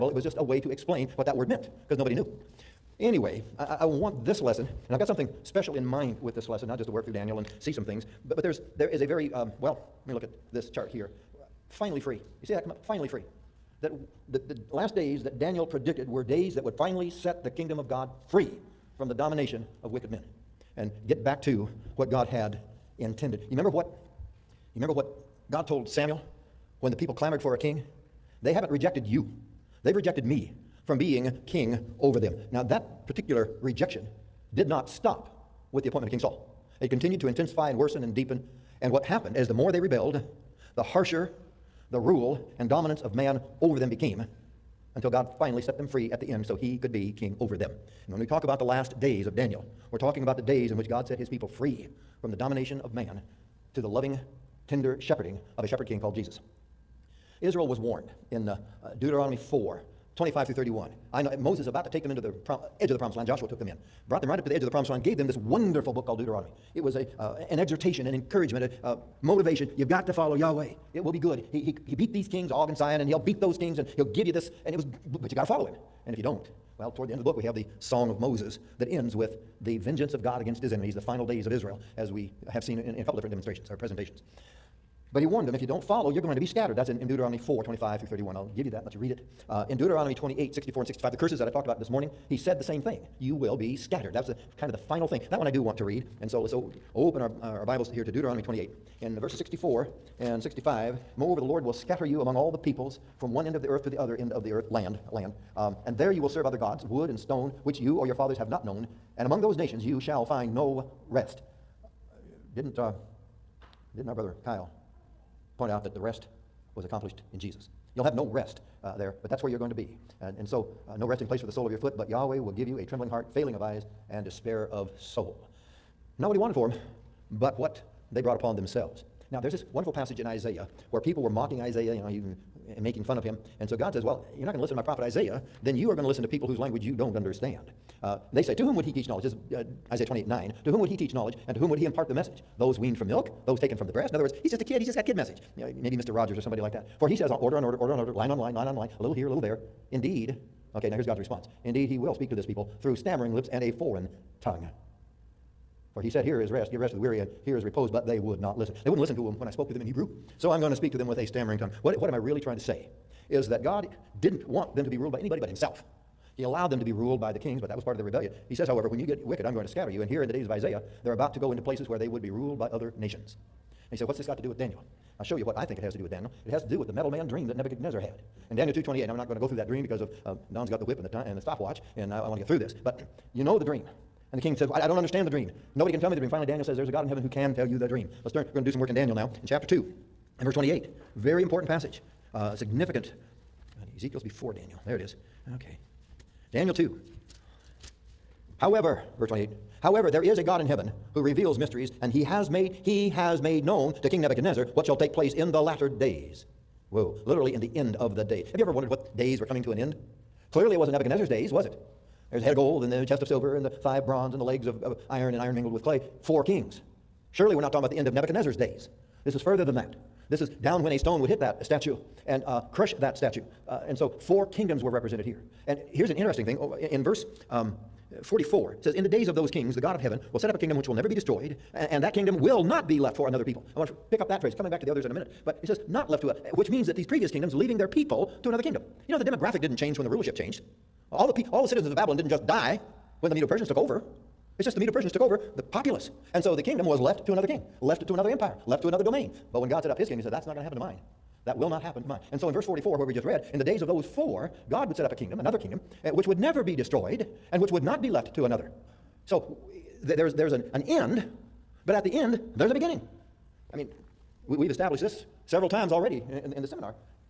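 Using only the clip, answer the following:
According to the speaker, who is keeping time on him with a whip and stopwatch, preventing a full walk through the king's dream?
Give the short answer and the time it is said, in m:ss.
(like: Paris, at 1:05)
Don, at 3:00.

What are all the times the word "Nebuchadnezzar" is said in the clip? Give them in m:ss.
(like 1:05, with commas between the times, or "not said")
2:57, 3:24, 3:30, 3:38.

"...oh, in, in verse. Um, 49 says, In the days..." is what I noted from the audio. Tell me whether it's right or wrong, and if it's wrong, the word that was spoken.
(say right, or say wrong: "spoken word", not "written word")
wrong: "44", not "49".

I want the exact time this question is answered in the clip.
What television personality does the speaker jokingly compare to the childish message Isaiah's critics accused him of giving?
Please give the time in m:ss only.
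2:25.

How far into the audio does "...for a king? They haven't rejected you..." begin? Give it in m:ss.
0:27.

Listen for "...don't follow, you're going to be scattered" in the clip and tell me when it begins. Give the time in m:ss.
1:25.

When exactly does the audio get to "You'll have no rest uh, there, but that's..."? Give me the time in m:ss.
1:57.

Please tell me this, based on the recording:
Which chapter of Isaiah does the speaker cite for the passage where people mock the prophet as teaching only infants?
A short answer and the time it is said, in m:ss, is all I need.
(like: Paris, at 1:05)
29, at 2:19.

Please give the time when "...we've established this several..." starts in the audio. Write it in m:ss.
4:24.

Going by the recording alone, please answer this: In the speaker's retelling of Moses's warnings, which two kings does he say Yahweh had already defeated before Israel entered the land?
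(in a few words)
Og and Sihon.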